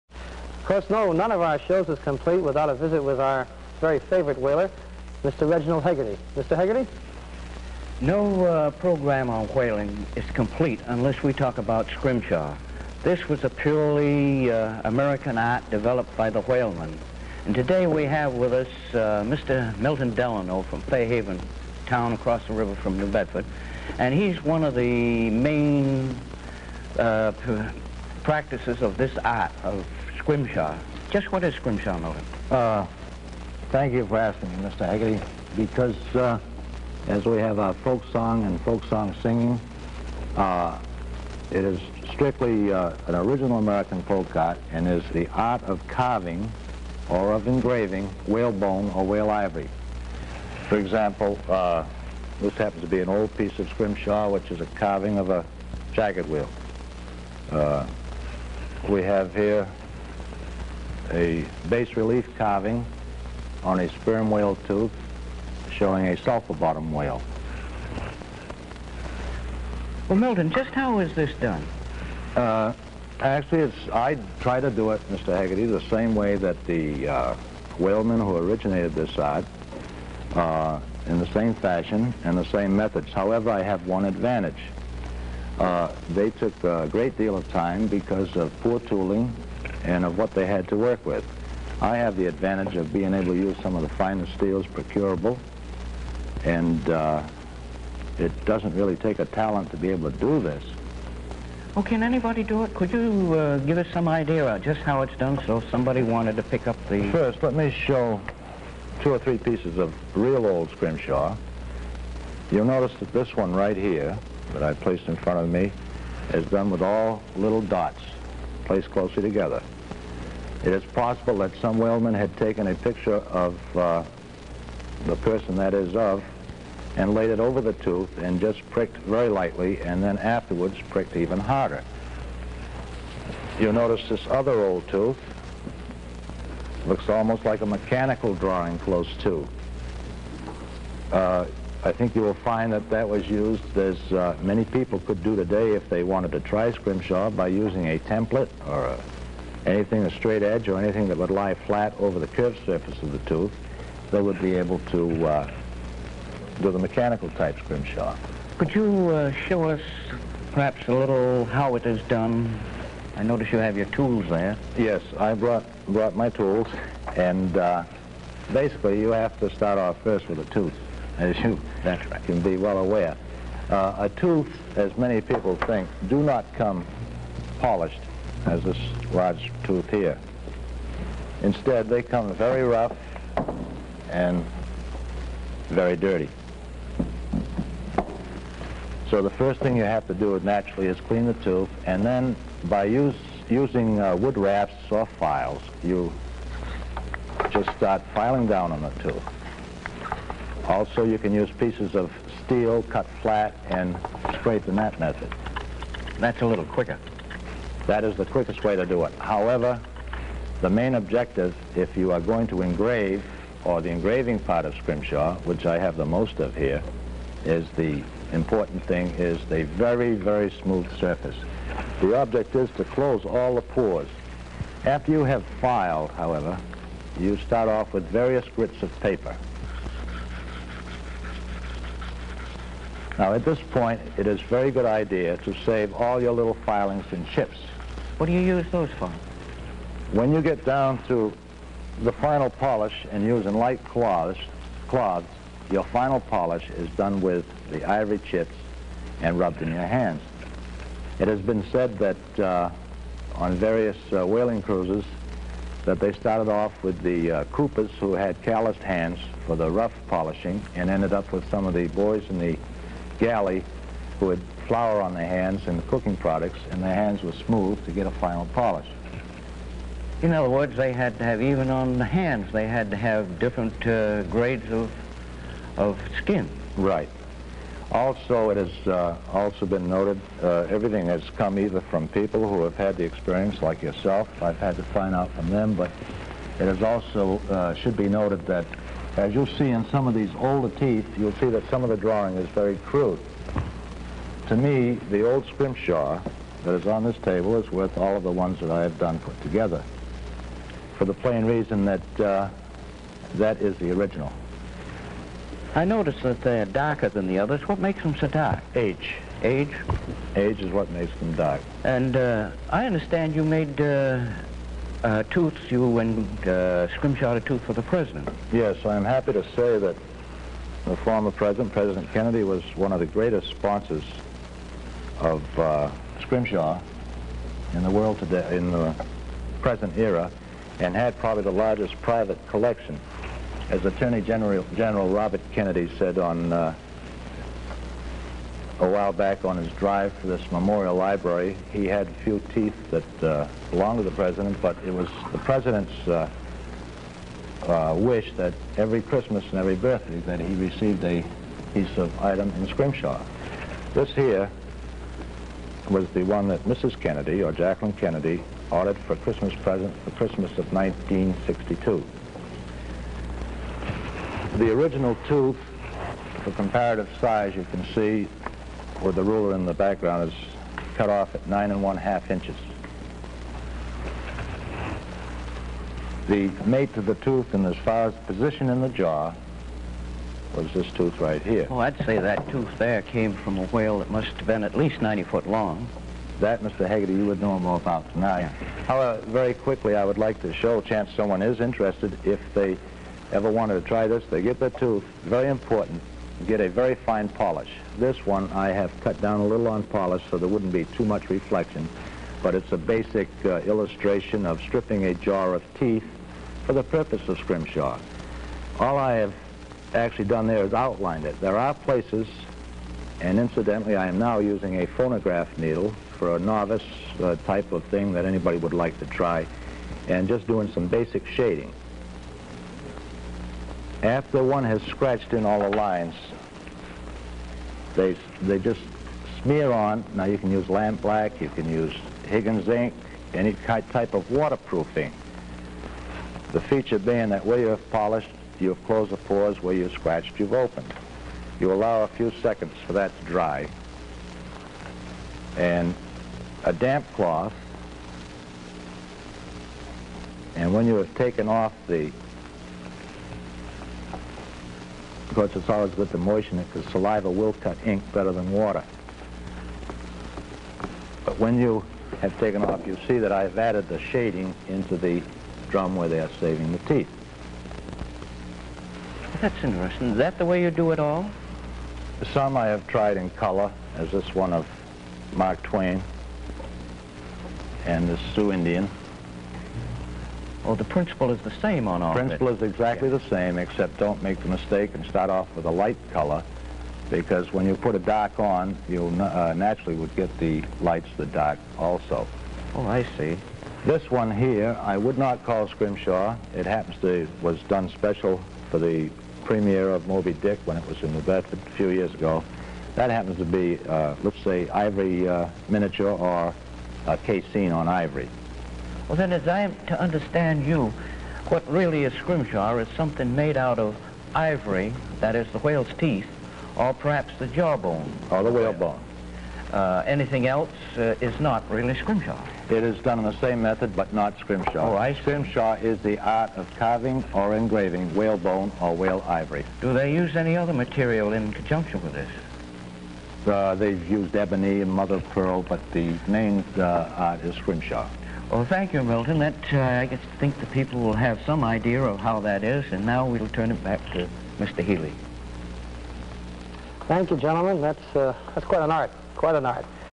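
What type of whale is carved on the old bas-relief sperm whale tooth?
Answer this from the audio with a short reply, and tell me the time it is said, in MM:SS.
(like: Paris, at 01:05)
sulfur bottom whale, at 01:06.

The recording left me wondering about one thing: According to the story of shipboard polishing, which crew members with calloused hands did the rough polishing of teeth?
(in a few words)
Coopers.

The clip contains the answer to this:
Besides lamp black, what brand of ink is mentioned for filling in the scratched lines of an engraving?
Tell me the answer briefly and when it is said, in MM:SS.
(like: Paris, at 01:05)
Higgins ink, at 07:12.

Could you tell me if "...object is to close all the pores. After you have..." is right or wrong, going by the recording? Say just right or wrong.
right.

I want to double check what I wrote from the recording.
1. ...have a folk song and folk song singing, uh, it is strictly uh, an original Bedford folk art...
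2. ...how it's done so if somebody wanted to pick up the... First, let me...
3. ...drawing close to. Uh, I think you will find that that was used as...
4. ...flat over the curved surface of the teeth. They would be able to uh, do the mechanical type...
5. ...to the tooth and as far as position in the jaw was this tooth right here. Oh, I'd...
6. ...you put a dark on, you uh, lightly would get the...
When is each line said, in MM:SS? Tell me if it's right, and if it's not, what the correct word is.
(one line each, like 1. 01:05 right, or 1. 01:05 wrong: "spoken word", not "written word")
1. 00:37 wrong: "American", not "Bedford"
2. 01:44 right
3. 02:18 right
4. 02:31 wrong: "tooth", not "teeth"
5. 06:16 right
6. 08:07 wrong: "naturally", not "lightly".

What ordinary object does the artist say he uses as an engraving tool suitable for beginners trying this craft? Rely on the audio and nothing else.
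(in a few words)
A phonograph needle.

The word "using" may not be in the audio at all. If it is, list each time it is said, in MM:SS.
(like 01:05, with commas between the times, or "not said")
02:27, 03:13, 04:03, 06:54.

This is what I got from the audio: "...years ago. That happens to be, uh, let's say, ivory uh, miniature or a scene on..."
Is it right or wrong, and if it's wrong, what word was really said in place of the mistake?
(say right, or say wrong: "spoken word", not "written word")
right.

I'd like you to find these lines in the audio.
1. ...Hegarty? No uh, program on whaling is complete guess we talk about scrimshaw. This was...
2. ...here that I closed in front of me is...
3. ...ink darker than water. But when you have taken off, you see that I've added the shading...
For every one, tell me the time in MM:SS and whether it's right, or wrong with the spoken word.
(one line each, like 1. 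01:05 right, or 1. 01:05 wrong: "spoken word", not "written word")
1. 00:06 wrong: "unless", not "guess"
2. 01:53 wrong: "placed", not "closed"
3. 07:37 wrong: "better", not "darker".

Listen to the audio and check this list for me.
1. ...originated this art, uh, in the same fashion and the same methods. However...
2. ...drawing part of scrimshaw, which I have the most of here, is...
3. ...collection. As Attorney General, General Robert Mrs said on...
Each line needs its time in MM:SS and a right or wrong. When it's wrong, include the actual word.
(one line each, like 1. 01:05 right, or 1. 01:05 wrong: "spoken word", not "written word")
1. 01:18 right
2. 03:33 wrong: "engraving", not "drawing"
3. 05:32 wrong: "Kennedy", not "Mrs".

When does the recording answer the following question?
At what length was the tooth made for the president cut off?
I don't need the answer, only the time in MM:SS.
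06:11.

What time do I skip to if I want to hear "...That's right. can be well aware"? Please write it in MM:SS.
02:51.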